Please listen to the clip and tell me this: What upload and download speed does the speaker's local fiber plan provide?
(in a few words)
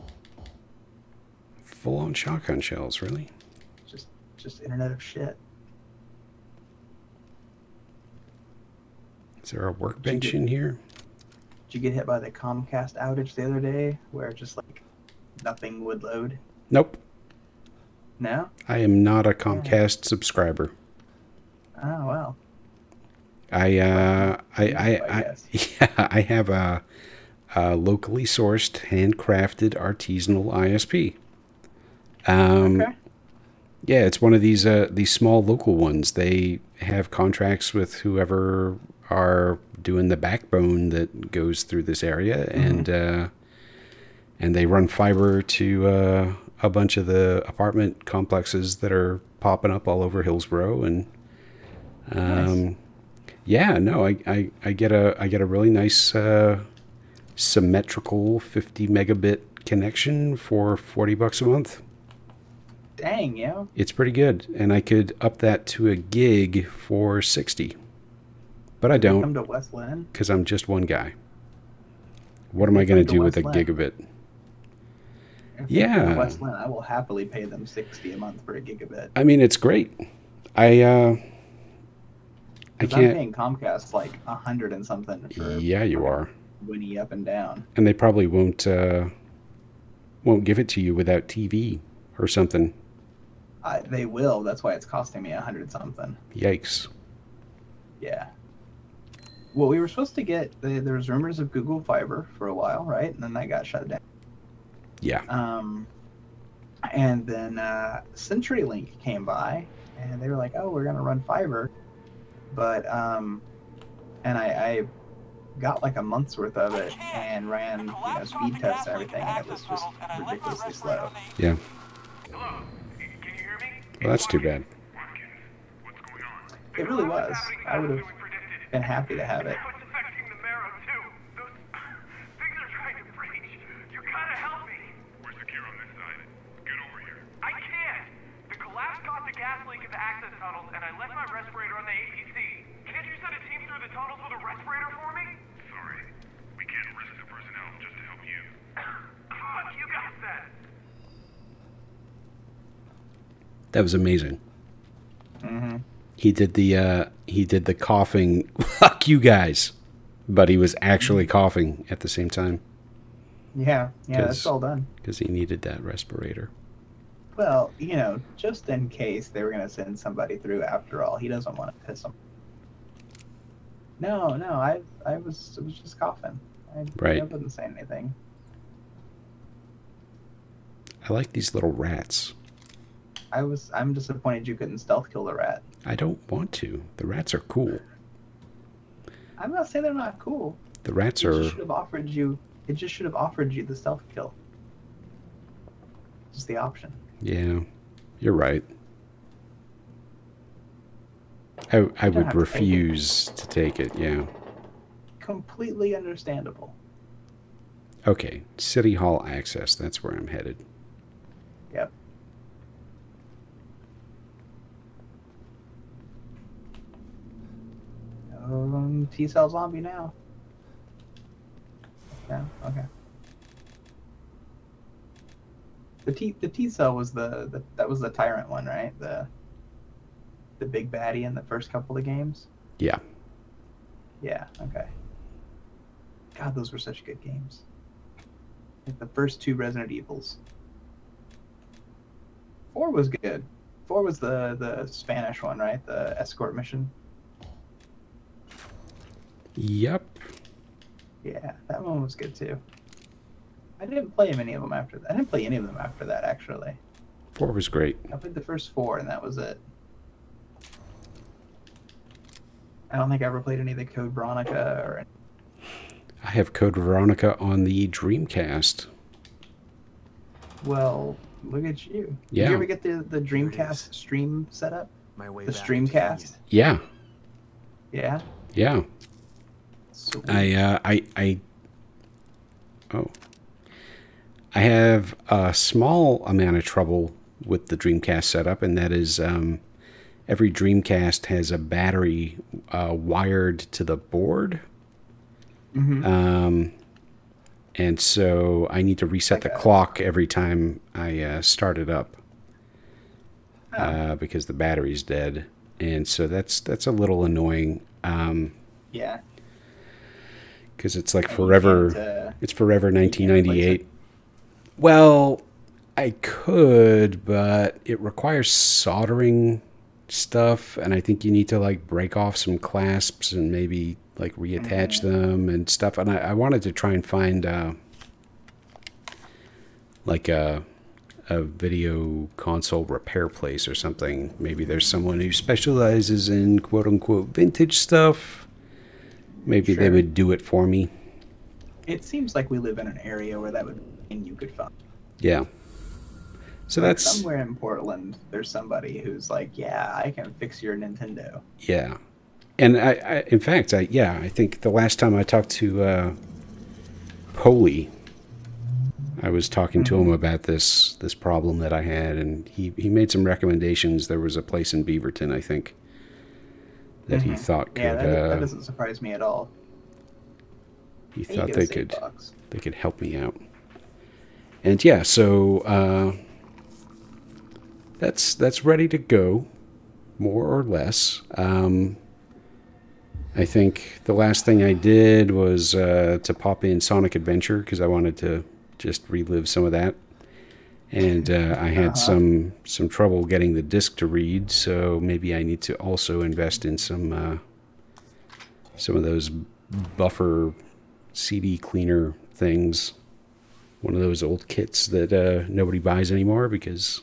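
50 megabit.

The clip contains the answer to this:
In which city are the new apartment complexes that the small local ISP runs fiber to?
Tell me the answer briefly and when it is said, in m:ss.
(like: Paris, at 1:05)
Hillsboro, at 0:50.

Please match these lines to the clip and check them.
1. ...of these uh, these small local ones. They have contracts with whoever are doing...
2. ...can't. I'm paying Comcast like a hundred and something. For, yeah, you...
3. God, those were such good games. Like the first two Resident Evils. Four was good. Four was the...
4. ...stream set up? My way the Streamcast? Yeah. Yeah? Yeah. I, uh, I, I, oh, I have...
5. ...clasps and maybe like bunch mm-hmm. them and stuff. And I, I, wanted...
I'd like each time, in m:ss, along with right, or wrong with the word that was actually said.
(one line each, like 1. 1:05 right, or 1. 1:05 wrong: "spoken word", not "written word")
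1. 0:34 right
2. 1:22 right
3. 3:56 right
4. 4:33 right
5. 5:22 wrong: "reattach", not "bunch".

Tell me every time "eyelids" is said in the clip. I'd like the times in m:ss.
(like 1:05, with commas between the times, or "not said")
not said.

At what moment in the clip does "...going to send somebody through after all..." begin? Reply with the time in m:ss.
2:49.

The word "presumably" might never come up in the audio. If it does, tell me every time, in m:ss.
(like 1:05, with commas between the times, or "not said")
not said.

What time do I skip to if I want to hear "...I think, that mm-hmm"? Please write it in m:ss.
6:05.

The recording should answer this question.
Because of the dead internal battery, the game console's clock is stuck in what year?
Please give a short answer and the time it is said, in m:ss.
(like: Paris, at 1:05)
1998, at 5:12.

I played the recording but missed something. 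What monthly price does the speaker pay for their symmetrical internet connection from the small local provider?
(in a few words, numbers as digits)
$40.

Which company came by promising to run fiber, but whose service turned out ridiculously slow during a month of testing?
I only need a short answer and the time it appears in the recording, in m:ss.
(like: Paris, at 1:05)
CenturyLink, at 1:48.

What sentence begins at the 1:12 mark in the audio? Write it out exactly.
What am I going to do with Linn.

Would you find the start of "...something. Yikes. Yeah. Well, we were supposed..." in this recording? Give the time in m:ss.
1:35.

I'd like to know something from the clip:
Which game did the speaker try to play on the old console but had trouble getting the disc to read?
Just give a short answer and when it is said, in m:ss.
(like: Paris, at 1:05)
Sonic Adventure, at 6:26.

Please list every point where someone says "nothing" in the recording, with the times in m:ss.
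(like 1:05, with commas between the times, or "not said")
0:15.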